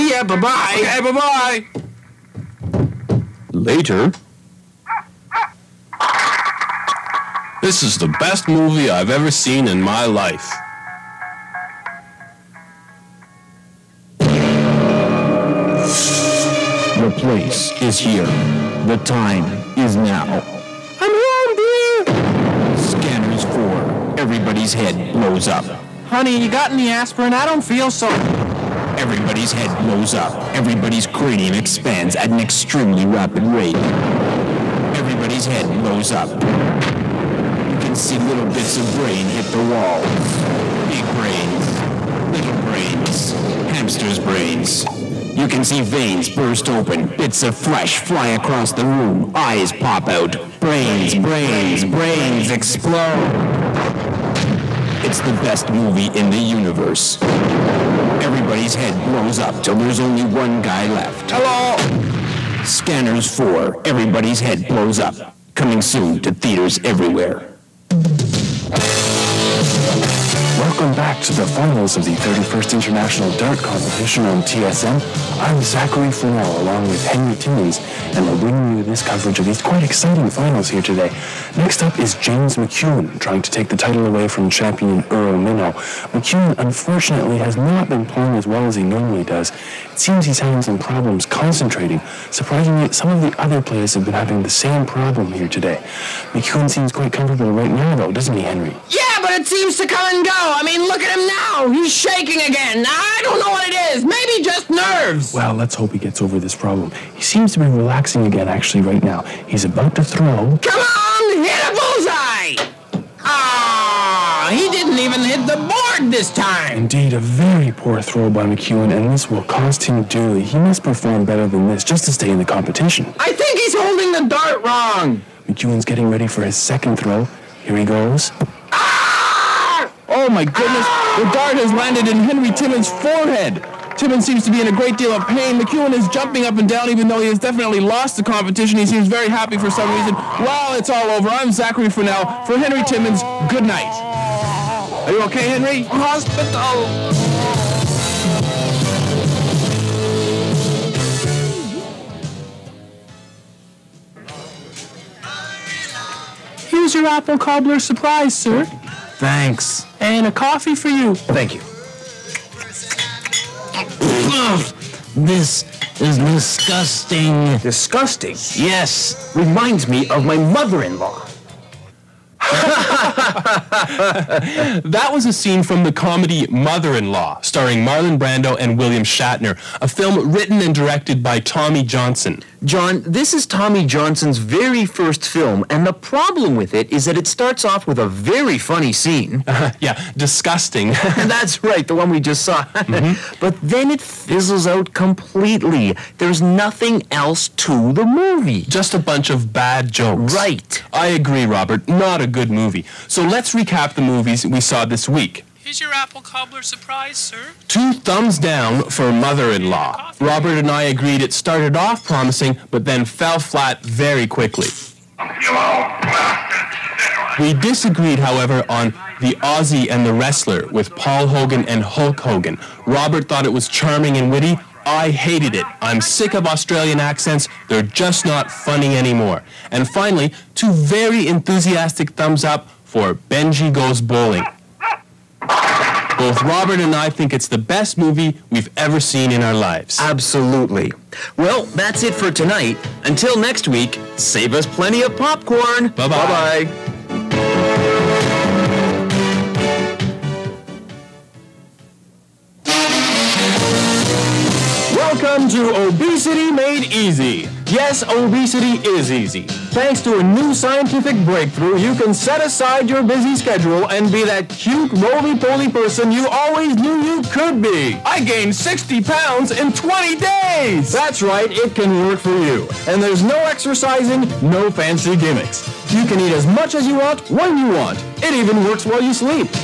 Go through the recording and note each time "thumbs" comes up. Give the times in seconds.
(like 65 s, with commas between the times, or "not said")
207 s, 232 s.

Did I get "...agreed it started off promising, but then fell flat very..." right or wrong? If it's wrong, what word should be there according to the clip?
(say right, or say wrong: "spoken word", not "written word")
right.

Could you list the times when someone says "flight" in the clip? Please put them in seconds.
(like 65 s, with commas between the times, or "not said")
not said.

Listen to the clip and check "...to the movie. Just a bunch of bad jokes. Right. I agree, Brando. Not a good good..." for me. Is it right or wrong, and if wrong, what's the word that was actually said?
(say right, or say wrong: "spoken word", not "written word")
wrong: "Robert", not "Brando".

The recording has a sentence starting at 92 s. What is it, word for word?
Surprisingly, some of the other players have been having the same problem here today.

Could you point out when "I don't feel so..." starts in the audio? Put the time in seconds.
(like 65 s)
27 s.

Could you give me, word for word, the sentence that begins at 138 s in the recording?
He seems very happy for some reason.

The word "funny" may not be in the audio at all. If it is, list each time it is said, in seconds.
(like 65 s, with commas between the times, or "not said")
188 s, 228 s.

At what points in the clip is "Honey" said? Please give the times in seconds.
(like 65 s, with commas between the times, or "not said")
26 s.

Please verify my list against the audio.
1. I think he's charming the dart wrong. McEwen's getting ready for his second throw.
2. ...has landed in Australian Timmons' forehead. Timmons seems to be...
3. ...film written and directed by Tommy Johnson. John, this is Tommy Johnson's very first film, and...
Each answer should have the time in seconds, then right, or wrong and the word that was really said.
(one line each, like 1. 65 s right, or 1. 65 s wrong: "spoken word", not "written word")
1. 123 s wrong: "holding", not "charming"
2. 131 s wrong: "Henry", not "Australian"
3. 179 s right.